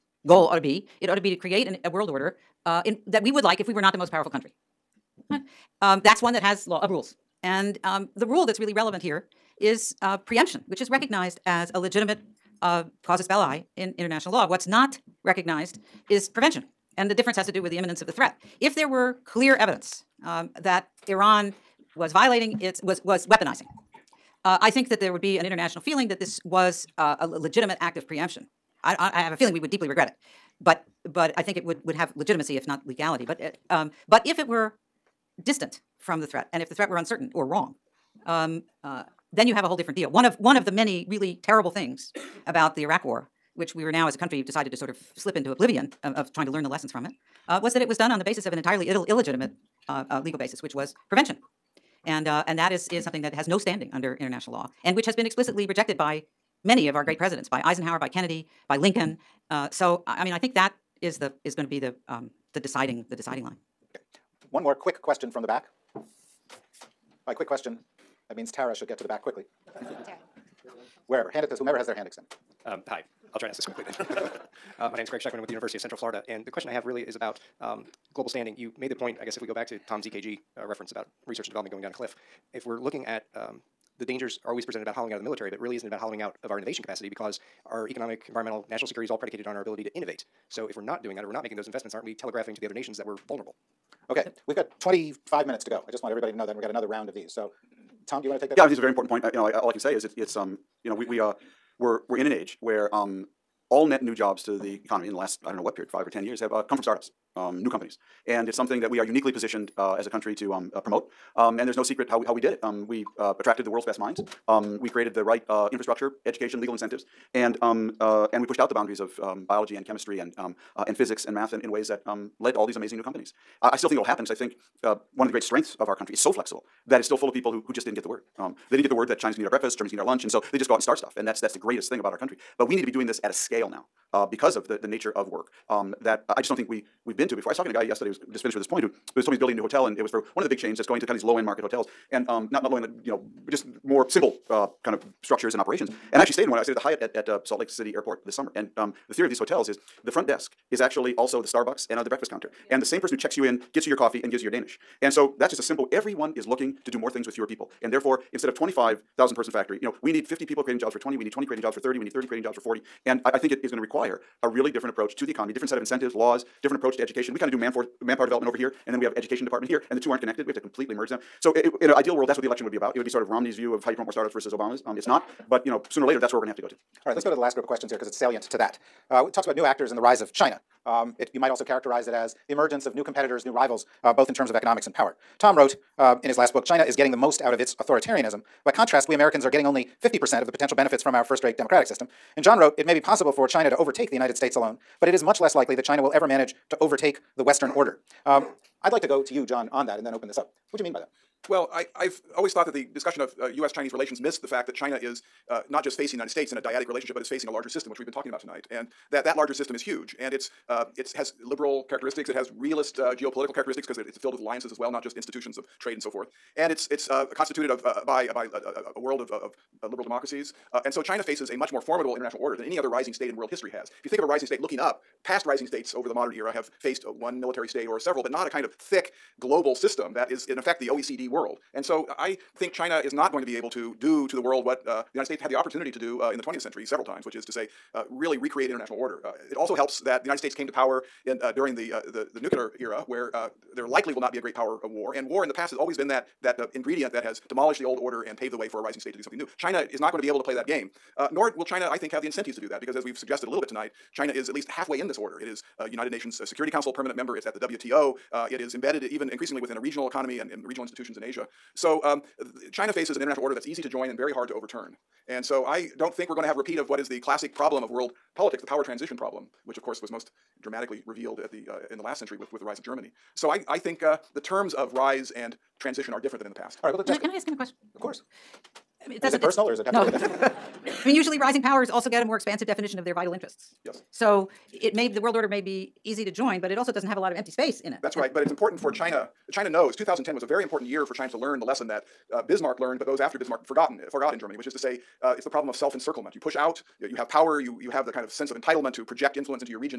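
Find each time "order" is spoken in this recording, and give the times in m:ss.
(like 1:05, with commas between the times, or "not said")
0:02, 3:17, 3:42, 3:58, 4:07, 4:15, 4:23, 4:45.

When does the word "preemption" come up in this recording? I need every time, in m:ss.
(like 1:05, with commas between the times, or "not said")
0:10, 0:28.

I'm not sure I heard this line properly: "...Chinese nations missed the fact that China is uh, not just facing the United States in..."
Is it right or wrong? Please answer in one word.
wrong.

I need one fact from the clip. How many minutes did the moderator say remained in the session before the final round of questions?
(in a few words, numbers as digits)
25.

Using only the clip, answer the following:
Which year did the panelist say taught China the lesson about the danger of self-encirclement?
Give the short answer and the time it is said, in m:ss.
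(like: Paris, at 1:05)
2010, at 4:49.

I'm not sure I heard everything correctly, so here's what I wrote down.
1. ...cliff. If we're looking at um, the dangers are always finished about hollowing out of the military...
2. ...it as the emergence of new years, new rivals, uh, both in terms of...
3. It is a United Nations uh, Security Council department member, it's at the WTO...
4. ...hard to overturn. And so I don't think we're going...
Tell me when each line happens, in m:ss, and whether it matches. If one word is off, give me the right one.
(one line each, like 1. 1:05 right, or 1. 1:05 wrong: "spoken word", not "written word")
1. 1:21 wrong: "presented", not "finished"
2. 3:02 wrong: "competitors", not "years"
3. 4:15 wrong: "permanent", not "department"
4. 4:24 right.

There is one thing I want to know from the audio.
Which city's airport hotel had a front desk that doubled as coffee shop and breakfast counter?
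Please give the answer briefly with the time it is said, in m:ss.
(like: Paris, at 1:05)
Salt Lake City, at 2:27.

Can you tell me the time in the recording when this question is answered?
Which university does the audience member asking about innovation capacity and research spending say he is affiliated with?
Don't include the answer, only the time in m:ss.
1:15.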